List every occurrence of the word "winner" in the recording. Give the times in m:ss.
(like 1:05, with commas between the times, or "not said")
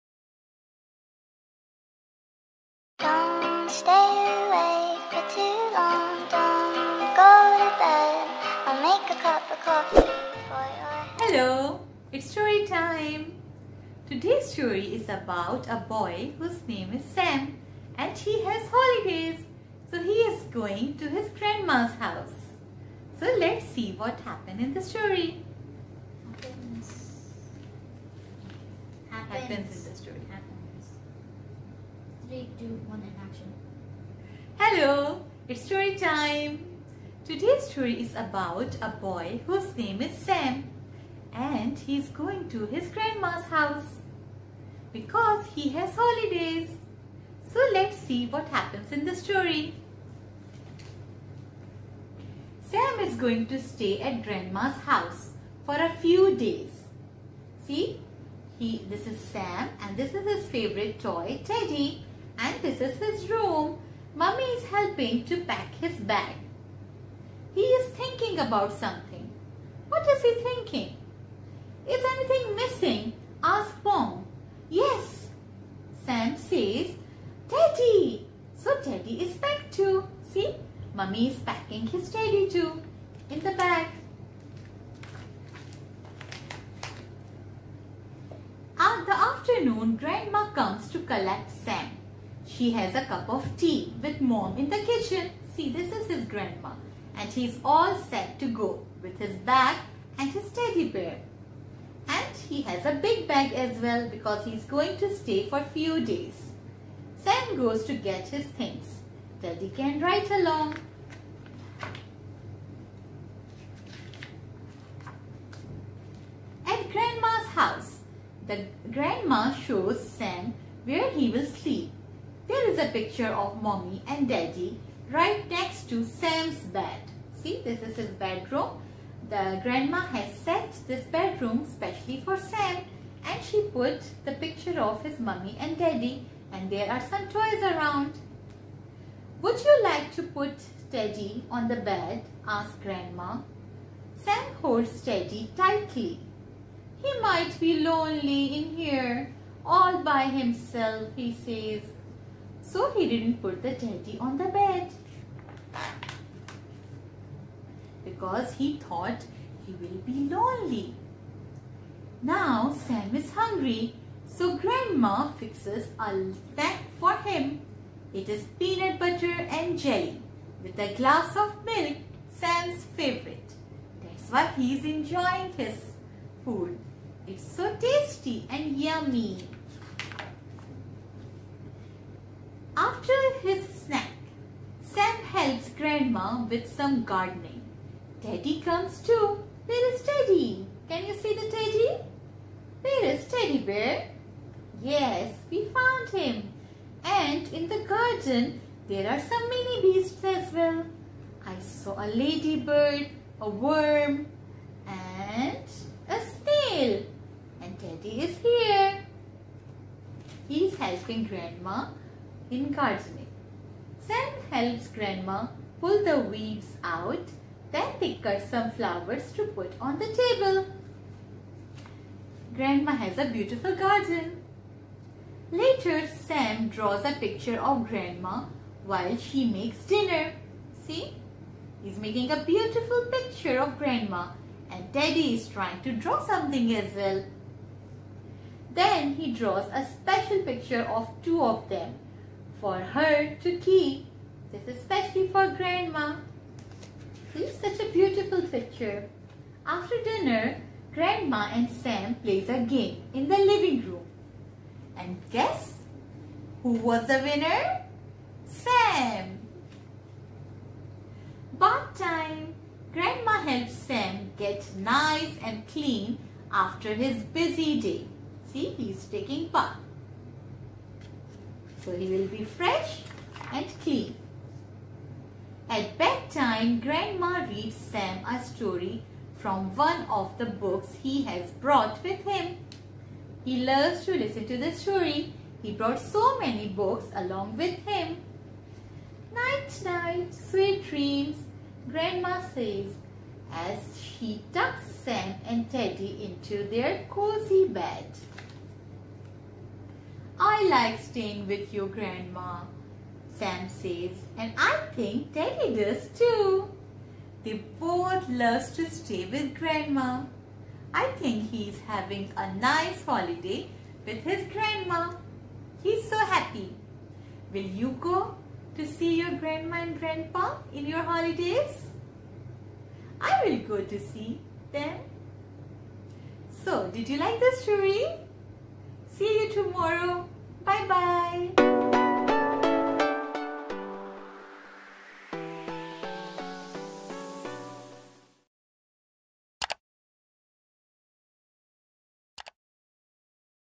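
4:17.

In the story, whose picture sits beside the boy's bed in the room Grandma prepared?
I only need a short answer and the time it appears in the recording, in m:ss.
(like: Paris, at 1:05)
Mummy and daddy, at 2:03.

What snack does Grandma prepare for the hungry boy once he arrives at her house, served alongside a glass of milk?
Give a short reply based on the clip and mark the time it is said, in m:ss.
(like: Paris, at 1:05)
Peanut butter and jelly, at 2:48.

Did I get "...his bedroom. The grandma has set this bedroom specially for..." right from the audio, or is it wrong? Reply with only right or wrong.
right.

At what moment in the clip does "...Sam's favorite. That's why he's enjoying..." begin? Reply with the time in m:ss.
2:52.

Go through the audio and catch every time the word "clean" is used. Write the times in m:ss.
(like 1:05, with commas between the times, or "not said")
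4:25, 4:33.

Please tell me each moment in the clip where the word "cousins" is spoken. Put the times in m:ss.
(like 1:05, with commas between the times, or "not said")
not said.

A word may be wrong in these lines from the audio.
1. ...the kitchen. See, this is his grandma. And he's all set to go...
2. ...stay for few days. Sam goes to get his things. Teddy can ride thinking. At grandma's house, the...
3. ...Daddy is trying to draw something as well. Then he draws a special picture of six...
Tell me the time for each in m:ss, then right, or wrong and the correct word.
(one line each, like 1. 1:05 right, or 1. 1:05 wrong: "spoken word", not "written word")
1. 1:34 right
2. 1:45 wrong: "along", not "thinking"
3. 3:54 wrong: "two", not "six".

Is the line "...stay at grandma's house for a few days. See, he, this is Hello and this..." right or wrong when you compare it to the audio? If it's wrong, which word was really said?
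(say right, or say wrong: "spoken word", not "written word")
wrong: "Sam", not "Hello".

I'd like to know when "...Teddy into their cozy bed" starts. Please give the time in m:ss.
4:55.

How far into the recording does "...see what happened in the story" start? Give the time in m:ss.
0:23.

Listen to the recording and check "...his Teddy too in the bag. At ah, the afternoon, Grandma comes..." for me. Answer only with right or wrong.
right.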